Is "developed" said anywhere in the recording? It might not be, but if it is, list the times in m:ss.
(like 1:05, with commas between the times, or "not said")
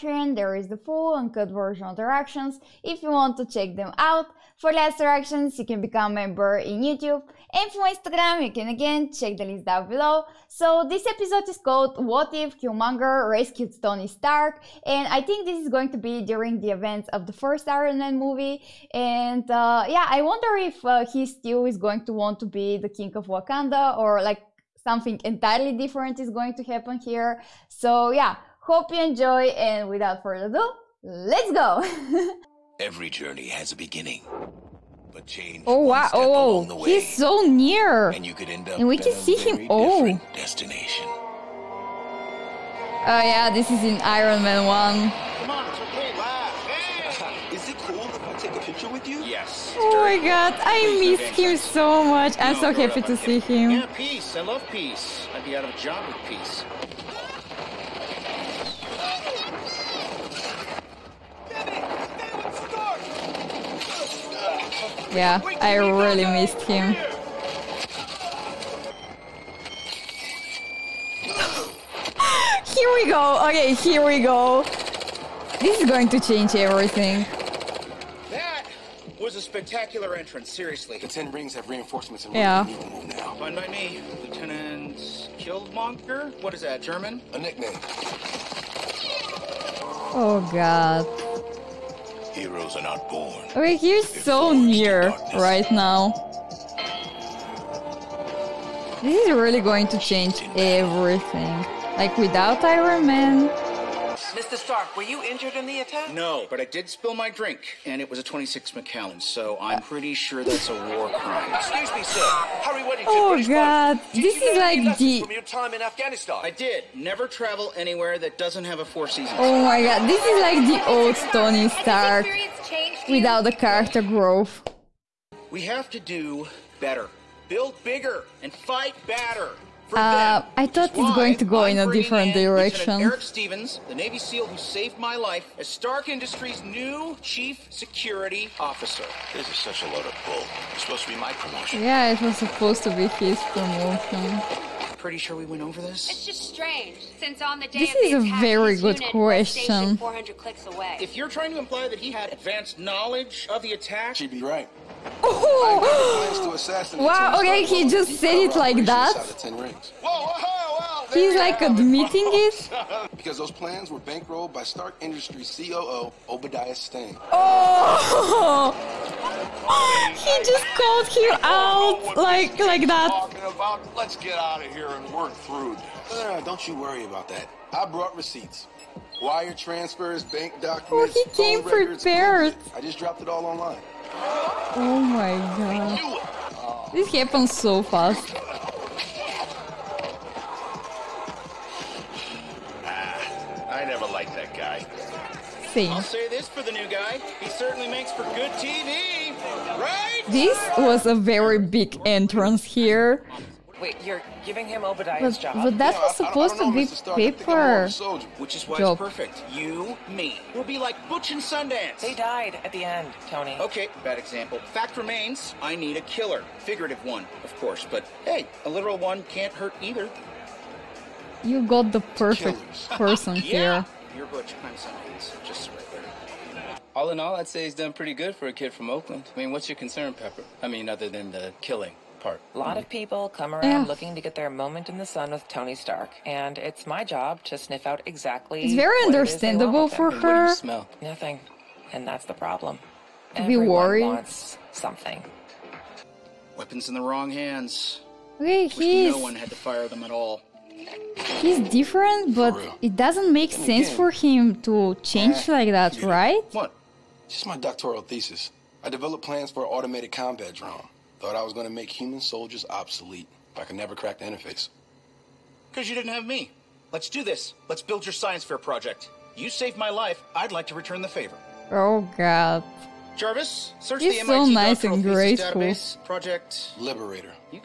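4:18.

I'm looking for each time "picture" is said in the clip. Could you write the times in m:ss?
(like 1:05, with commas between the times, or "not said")
0:48.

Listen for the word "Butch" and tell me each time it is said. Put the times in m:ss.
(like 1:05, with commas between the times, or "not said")
3:31, 3:44.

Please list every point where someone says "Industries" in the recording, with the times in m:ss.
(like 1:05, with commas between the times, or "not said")
2:16, 2:45.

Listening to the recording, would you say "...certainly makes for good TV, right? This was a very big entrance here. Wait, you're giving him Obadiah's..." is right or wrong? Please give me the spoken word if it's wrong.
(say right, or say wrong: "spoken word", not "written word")
right.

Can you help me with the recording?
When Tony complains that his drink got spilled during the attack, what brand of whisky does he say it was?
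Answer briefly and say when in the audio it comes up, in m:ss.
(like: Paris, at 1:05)
26 Macallan, at 1:48.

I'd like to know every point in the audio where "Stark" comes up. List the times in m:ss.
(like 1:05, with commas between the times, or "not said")
0:14, 1:44, 2:01, 2:15, 2:44, 3:26, 3:55.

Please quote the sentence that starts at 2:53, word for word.
Let's get out of here and work through this.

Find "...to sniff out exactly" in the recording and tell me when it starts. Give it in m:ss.
3:57.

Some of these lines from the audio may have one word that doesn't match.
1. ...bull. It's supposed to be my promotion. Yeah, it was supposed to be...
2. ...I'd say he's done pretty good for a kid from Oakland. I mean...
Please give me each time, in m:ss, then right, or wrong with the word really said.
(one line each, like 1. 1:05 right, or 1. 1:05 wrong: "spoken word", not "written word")
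1. 2:20 right
2. 3:47 right.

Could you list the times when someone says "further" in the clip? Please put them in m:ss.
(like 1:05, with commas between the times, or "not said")
0:30.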